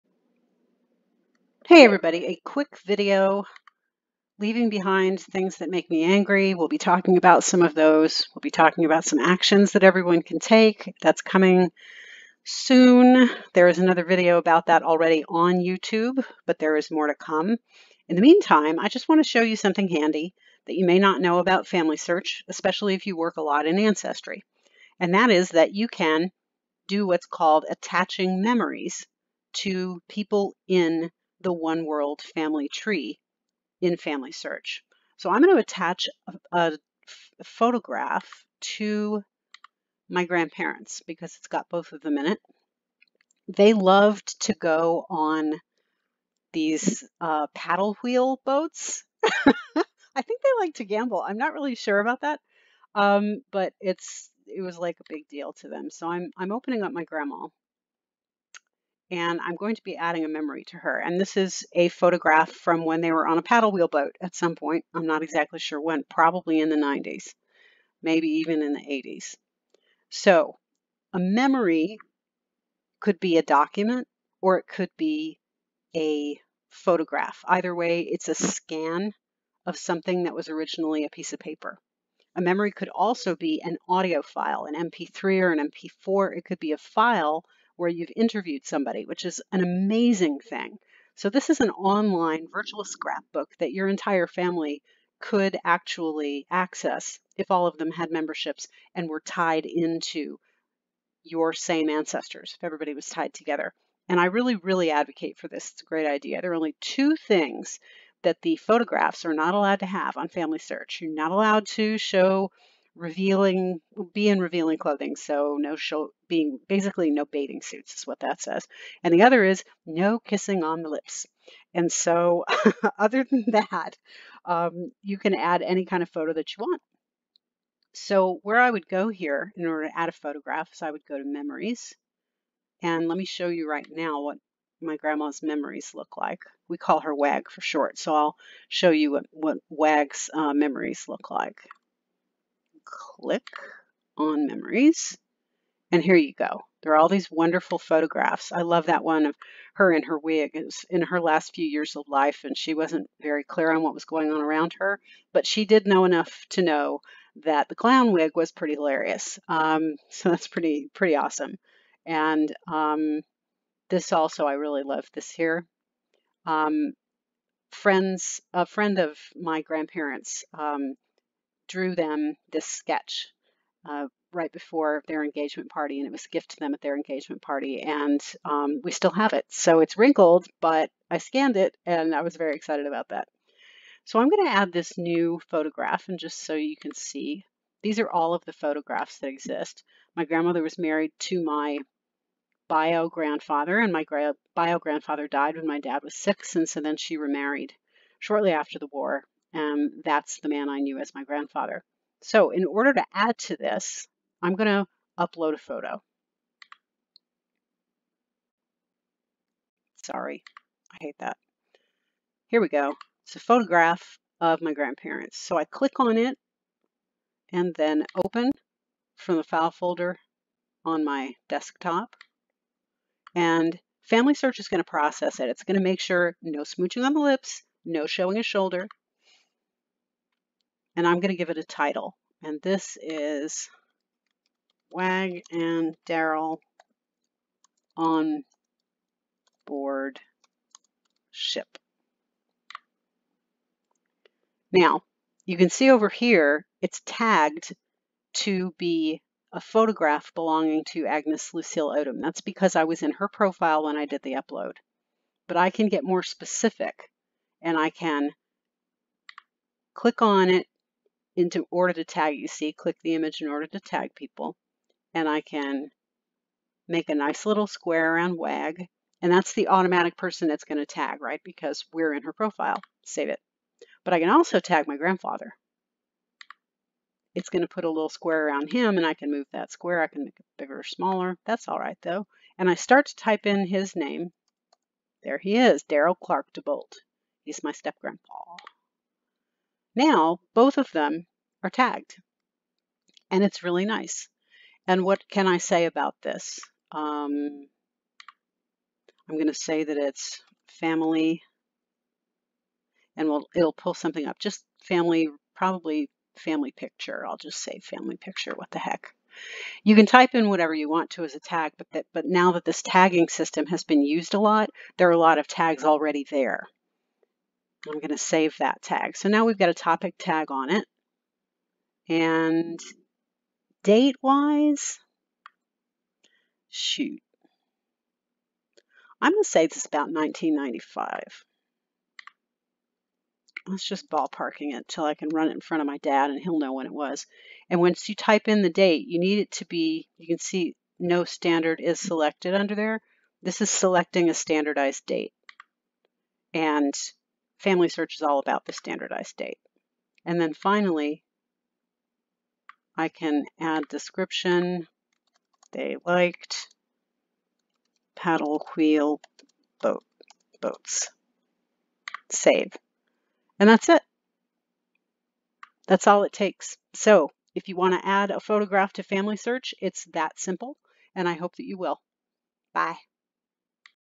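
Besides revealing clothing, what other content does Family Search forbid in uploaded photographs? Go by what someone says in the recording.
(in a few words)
Kissing on the lips.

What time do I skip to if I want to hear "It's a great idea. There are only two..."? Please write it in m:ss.
1:45.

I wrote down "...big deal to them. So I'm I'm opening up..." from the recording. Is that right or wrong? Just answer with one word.
right.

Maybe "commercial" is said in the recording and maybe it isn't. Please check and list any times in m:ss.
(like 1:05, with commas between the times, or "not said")
not said.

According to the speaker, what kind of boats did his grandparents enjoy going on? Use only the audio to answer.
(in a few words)
Paddle wheel boats.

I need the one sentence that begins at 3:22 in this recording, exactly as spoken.
So in order to add to this, I'm going to upload a photo.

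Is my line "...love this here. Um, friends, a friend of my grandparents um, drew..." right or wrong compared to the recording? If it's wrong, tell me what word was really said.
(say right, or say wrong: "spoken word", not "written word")
right.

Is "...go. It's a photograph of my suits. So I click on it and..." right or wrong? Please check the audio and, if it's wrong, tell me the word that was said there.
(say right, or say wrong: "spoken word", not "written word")
wrong: "grandparents", not "suits".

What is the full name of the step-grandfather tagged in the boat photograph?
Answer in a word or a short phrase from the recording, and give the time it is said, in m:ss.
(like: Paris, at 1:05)
Daryl Clark DeBolt, at 4:45.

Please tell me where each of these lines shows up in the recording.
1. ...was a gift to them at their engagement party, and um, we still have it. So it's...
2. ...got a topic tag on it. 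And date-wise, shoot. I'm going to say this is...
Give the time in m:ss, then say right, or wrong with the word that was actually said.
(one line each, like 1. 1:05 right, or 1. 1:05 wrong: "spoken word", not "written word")
1. 2:56 right
2. 5:19 right.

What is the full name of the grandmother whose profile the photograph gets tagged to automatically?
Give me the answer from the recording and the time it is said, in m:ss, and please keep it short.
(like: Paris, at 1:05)
Agnes Lucille Odom, at 4:11.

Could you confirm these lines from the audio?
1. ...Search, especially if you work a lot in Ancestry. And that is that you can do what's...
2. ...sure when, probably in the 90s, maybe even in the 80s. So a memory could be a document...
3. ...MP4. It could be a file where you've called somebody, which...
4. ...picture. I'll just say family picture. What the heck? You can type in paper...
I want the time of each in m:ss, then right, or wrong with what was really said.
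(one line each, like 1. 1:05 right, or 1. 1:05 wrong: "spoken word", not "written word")
1. 0:21 right
2. 1:05 right
3. 1:25 wrong: "interviewed", not "called"
4. 5:06 wrong: "whatever", not "paper".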